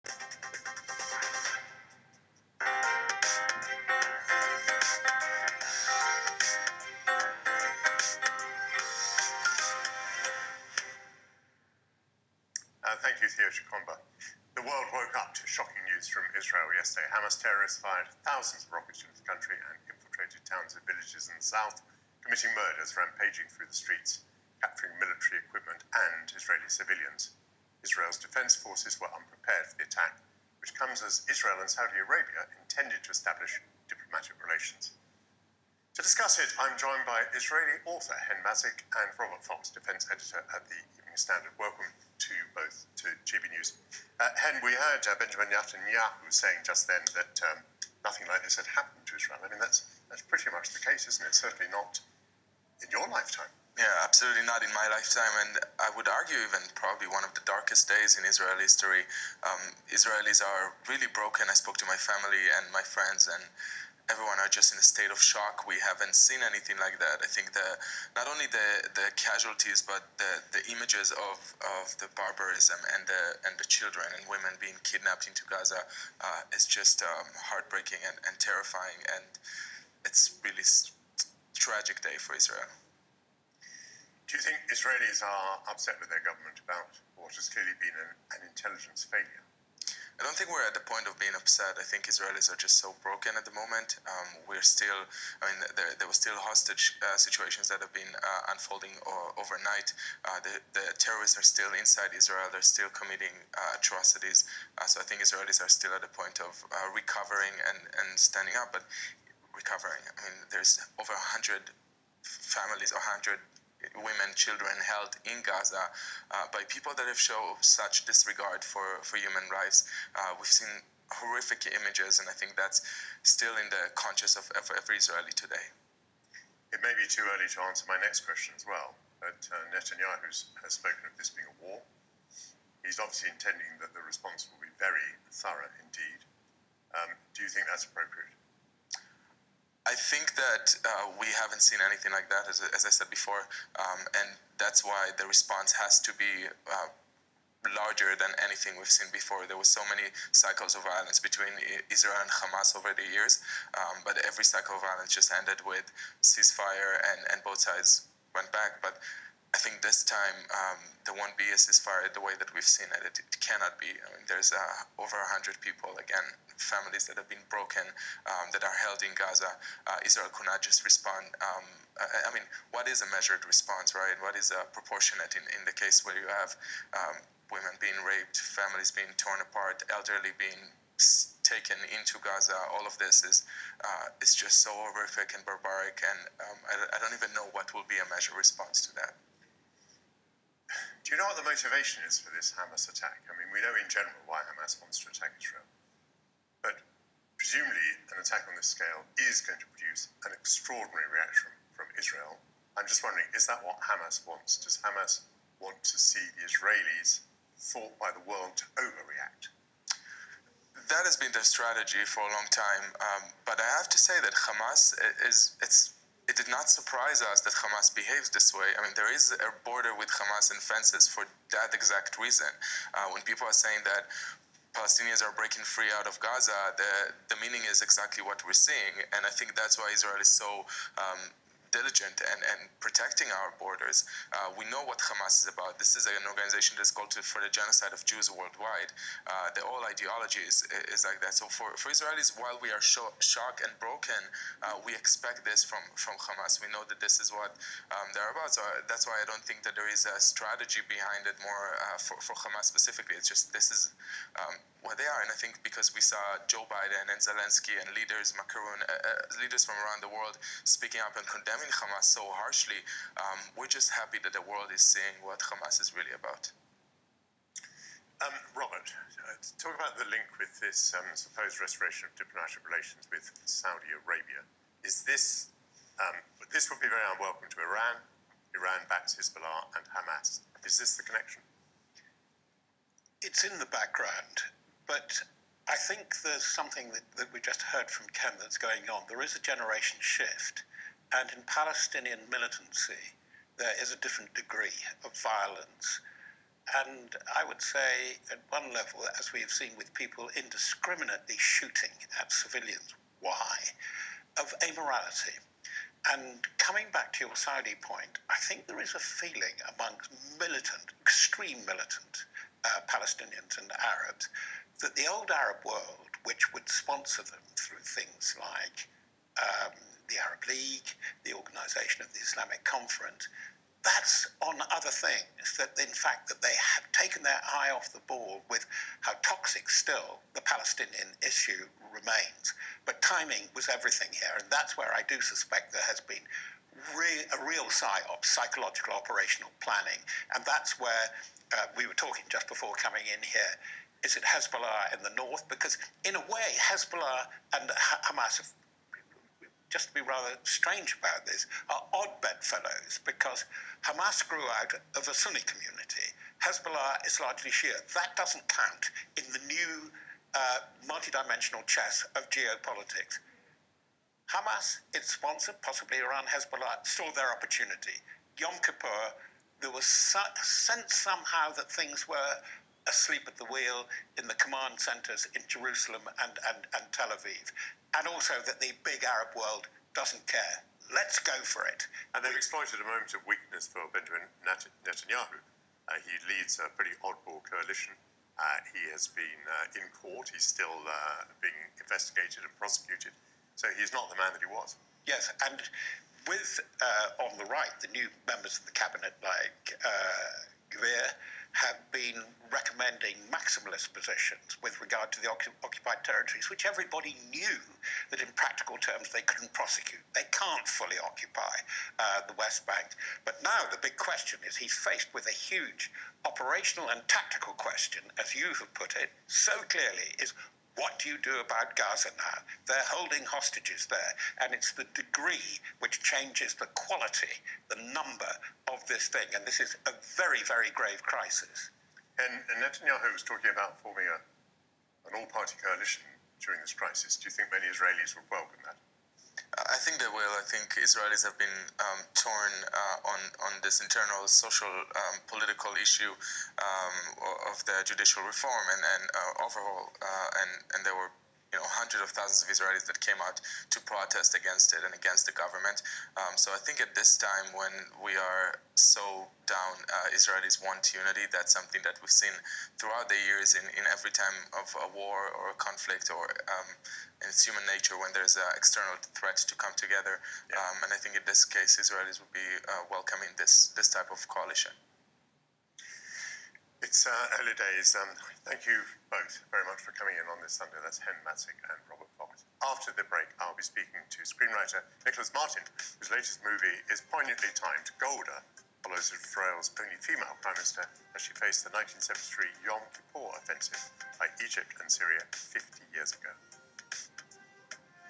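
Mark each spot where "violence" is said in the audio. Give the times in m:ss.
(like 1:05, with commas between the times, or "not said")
2:30, 2:34, 4:55.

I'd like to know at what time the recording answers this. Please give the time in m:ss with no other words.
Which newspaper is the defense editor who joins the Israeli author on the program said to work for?
0:40.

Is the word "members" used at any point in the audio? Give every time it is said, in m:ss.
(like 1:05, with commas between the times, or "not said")
6:38.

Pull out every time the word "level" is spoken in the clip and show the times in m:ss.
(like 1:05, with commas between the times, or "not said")
4:58.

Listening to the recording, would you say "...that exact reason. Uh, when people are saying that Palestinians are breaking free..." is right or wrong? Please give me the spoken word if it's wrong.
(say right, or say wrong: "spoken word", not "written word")
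right.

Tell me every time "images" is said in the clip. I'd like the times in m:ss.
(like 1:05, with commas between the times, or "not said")
1:10, 2:01.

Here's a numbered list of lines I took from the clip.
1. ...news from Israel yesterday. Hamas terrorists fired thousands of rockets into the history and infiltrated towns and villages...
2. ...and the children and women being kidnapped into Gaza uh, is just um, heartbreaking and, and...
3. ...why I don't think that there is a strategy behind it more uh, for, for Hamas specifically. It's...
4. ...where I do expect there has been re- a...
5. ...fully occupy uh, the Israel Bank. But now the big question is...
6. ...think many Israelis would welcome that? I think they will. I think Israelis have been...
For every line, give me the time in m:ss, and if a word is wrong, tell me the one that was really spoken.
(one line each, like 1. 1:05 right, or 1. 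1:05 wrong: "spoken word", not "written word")
1. 0:15 wrong: "country", not "history"
2. 1:13 right
3. 4:09 right
4. 5:34 wrong: "suspect", not "expect"
5. 6:50 wrong: "West", not "Israel"
6. 7:17 right.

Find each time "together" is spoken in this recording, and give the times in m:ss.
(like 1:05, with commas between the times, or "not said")
7:49.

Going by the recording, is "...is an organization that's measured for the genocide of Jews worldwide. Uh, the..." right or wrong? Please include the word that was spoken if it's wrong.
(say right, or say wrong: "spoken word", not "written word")
wrong: "called", not "measured".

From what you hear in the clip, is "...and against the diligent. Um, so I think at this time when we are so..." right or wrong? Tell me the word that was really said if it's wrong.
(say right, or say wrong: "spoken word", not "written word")
wrong: "government", not "diligent".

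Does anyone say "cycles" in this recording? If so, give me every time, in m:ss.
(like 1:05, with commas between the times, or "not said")
2:30, 2:34.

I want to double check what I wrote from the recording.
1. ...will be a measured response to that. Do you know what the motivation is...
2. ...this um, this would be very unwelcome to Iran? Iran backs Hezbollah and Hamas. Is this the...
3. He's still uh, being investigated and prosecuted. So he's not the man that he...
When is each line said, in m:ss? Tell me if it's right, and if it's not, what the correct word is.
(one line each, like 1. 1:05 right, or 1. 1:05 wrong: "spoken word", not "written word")
1. 3:07 right
2. 4:35 right
3. 6:30 right.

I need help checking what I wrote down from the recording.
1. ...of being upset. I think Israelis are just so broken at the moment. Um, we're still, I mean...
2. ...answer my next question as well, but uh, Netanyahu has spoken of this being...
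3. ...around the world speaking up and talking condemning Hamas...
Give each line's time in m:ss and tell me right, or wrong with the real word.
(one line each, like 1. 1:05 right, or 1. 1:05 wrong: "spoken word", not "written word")
1. 1:31 right
2. 2:07 right
3. 4:19 wrong: "condemning", not "talking".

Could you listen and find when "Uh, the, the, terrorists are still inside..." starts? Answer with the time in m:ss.
1:40.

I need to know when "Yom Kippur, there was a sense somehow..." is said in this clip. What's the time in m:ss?
6:08.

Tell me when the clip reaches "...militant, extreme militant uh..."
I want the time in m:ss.
5:10.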